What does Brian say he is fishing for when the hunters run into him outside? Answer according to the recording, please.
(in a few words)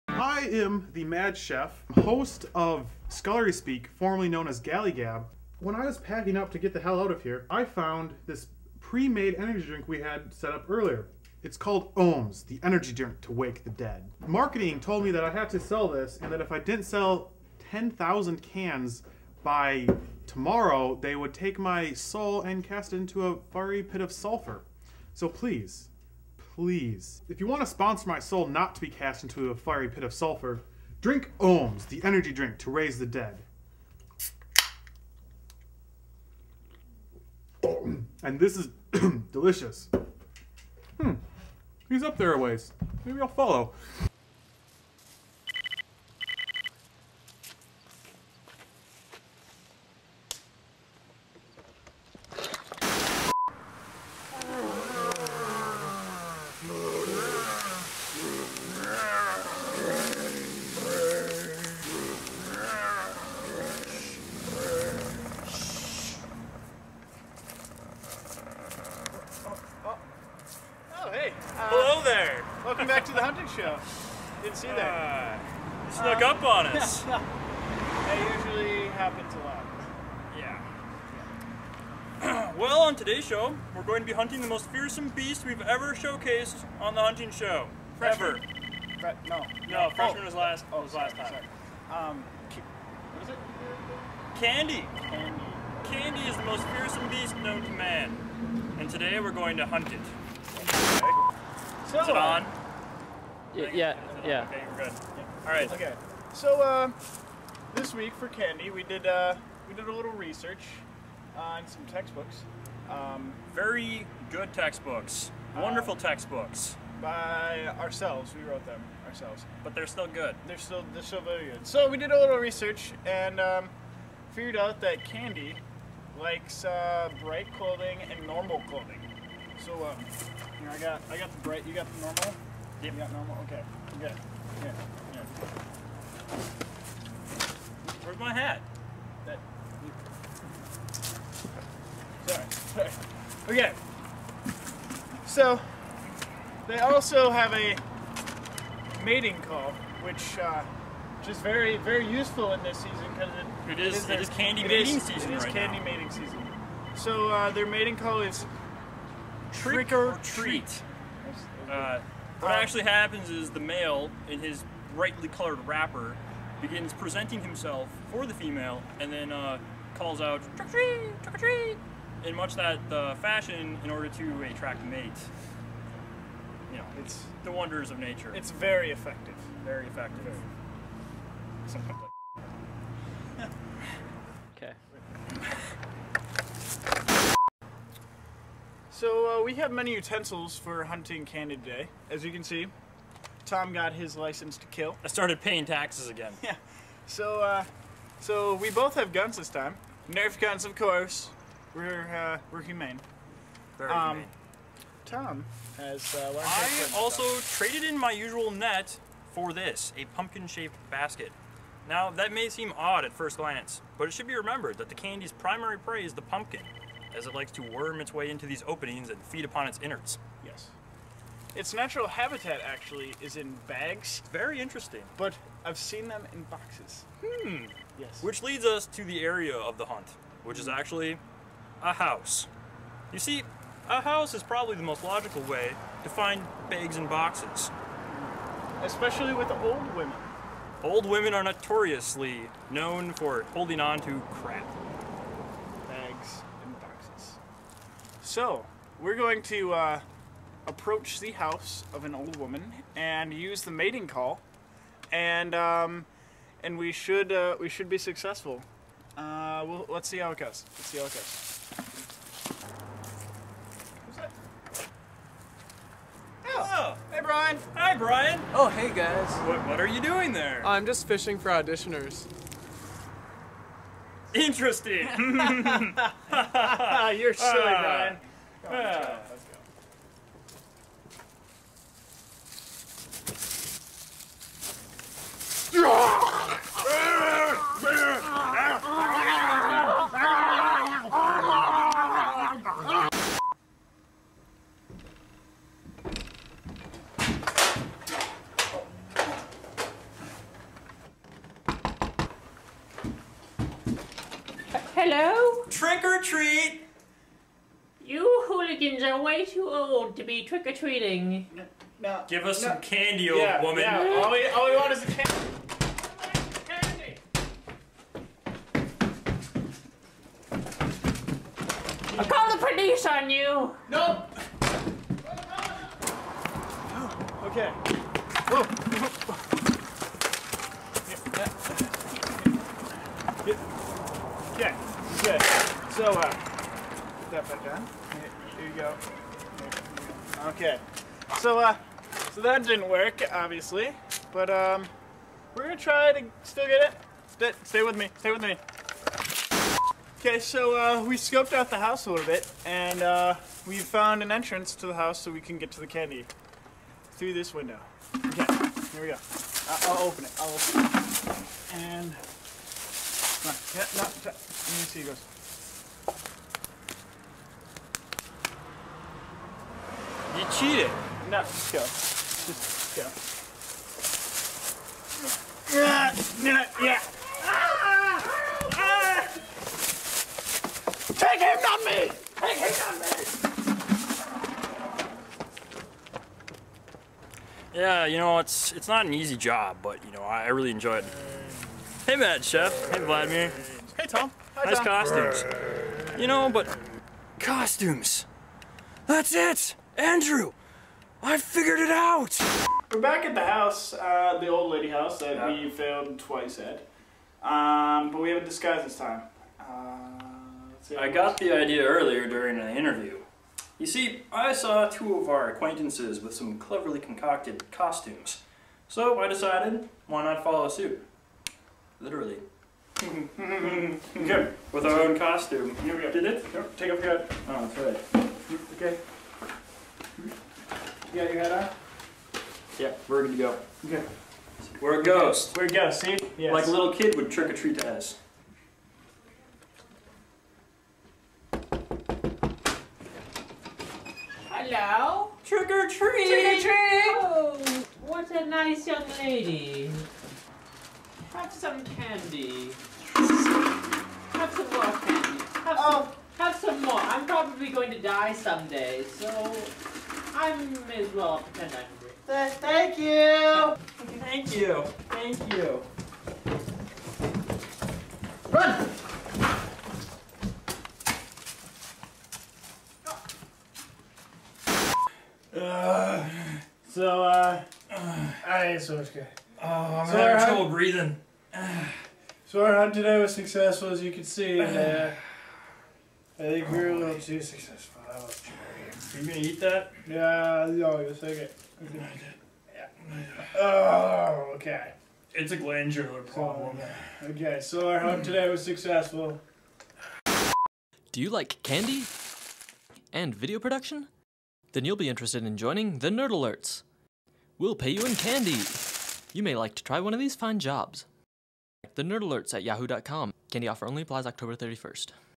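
Auditioners.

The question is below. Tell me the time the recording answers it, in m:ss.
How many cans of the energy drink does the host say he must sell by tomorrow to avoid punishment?
0:17.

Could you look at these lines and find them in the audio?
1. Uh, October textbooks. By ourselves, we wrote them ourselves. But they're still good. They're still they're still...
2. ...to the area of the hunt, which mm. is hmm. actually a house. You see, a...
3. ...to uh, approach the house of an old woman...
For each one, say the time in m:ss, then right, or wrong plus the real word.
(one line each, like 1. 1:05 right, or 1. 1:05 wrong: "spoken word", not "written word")
1. 1:55 wrong: "Wonderful", not "October"
2. 3:48 right
3. 4:09 right.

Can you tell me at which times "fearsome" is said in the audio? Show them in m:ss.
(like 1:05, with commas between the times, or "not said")
1:24, 1:36.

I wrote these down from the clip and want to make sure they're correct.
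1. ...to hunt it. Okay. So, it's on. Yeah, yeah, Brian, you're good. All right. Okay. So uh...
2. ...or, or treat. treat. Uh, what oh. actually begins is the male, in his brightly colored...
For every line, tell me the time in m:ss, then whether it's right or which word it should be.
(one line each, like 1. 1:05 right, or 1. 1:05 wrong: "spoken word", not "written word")
1. 1:39 wrong: "Okay", not "Brian"
2. 2:39 wrong: "happens", not "begins".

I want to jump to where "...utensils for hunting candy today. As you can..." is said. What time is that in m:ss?
3:09.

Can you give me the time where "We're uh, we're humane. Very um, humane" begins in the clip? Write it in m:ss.
3:21.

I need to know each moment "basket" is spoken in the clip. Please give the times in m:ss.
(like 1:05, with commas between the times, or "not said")
3:30.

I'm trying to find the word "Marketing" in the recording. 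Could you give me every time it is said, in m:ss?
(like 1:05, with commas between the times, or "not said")
0:14.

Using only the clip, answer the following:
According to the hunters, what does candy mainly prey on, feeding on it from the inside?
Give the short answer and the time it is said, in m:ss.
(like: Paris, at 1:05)
The pumpkin, at 3:36.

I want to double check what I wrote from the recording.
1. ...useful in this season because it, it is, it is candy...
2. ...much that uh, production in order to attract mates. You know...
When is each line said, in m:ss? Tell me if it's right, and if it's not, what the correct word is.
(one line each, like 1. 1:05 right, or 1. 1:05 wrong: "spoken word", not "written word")
1. 2:32 right
2. 2:52 wrong: "fashion", not "production".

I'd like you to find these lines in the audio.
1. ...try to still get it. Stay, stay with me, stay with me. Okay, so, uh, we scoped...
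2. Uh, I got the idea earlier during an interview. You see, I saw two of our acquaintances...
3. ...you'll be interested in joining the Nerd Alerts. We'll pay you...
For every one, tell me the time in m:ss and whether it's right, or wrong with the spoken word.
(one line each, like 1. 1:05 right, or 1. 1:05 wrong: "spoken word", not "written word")
1. 5:45 right
2. 6:49 right
3. 8:24 right.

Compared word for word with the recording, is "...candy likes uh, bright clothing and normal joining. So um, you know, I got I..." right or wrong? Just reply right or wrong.
wrong.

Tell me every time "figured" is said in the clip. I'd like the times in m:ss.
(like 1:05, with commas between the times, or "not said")
2:04, 6:41.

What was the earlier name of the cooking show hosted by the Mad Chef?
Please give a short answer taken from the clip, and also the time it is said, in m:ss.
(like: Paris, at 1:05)
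Galley Gab, at 0:04.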